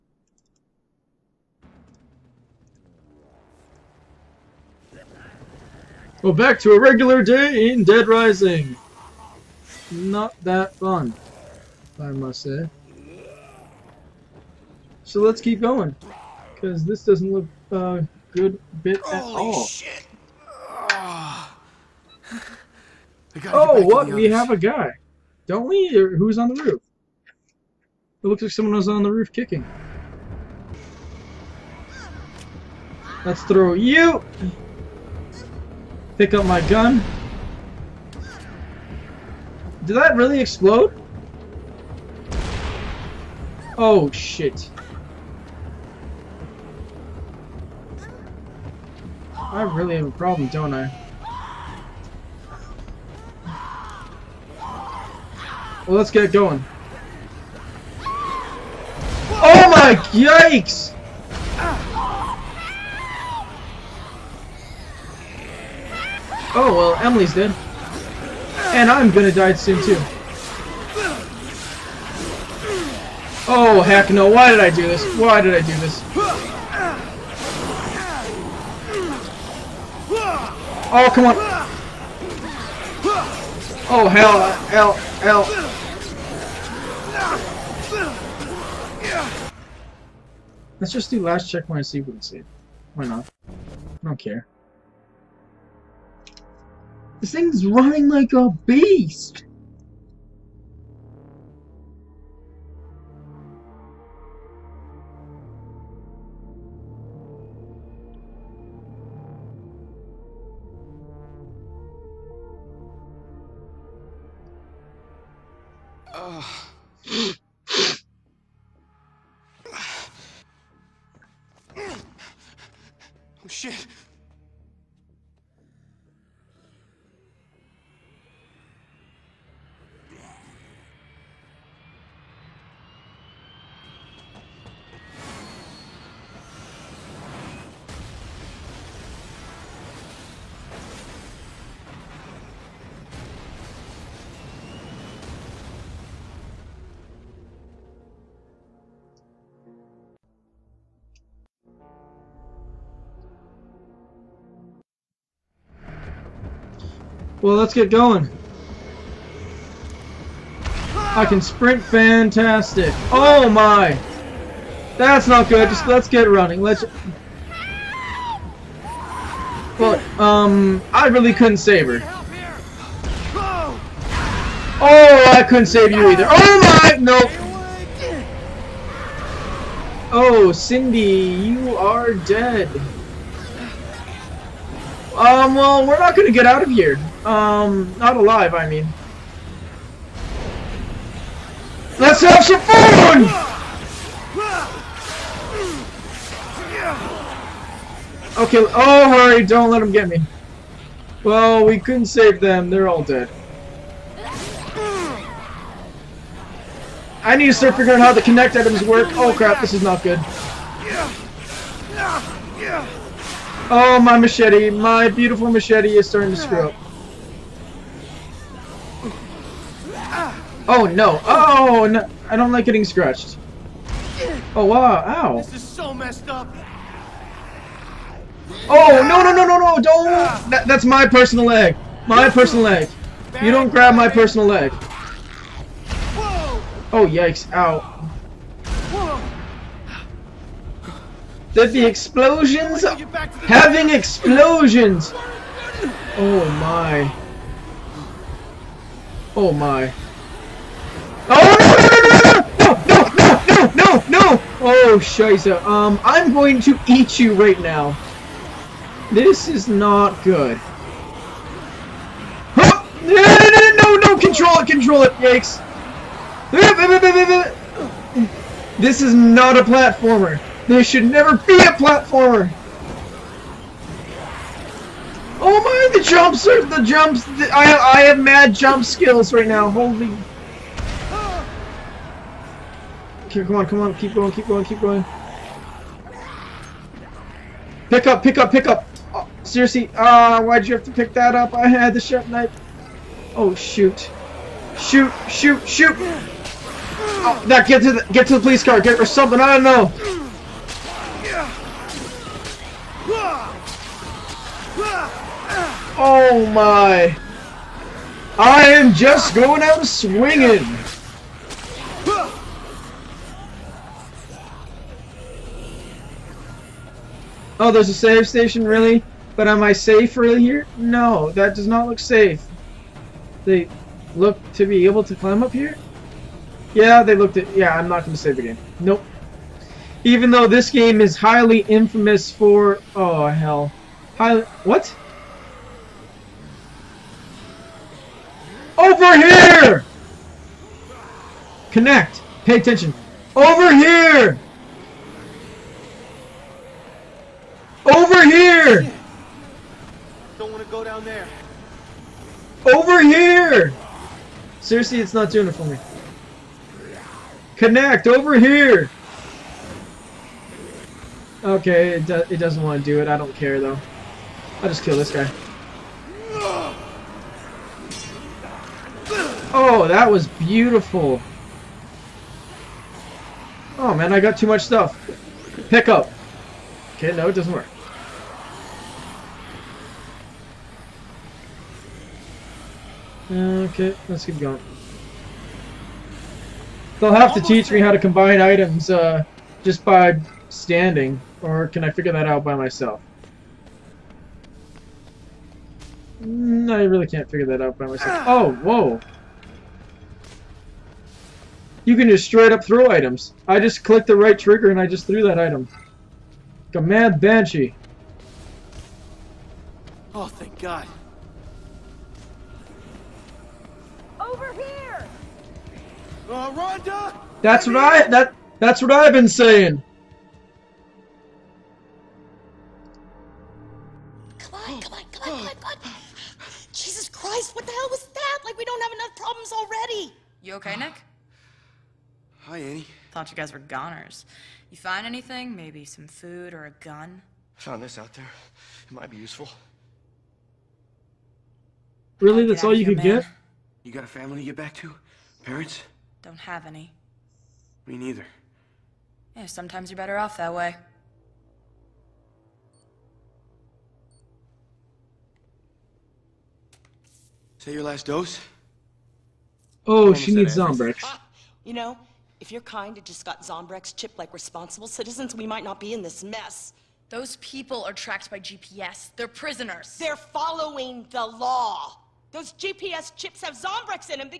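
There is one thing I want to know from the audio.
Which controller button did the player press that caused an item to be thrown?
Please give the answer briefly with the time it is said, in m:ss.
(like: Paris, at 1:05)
Right trigger, at 6:44.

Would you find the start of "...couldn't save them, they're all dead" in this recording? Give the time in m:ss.
3:21.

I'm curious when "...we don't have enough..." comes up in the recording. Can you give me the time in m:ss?
7:08.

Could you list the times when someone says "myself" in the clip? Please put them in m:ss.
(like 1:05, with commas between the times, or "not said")
6:32, 6:37.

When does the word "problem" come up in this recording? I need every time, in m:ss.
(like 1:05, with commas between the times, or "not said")
0:50, 7:09.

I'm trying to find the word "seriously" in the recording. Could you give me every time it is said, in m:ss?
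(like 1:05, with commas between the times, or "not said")
4:49, 5:54.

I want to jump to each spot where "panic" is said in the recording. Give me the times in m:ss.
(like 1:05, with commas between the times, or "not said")
not said.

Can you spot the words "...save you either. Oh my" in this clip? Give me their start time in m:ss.
2:55.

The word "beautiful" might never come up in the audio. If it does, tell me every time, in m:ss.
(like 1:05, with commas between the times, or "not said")
3:35, 6:10.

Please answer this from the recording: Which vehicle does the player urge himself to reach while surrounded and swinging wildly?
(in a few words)
Police car.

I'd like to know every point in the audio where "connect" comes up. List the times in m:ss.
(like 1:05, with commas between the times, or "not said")
3:28, 5:41, 5:57.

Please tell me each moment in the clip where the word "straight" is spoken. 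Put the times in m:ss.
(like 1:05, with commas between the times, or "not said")
6:42.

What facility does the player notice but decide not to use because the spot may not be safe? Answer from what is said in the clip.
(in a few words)
Save station.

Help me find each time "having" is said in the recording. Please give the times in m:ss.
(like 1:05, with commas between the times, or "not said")
4:02.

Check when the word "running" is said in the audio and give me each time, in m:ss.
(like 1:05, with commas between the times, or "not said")
1:37, 2:46.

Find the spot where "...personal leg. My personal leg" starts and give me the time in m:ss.
3:51.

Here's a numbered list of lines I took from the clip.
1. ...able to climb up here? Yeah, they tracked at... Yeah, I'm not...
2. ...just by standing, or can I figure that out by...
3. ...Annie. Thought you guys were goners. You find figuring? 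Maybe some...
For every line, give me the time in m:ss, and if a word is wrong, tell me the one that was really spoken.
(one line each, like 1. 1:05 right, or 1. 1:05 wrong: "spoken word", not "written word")
1. 5:24 wrong: "looked", not "tracked"
2. 6:29 right
3. 7:12 wrong: "anything", not "figuring".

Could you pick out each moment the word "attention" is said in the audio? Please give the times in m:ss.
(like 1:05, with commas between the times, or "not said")
5:42.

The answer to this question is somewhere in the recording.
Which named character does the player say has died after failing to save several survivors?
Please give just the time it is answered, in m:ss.
3:00.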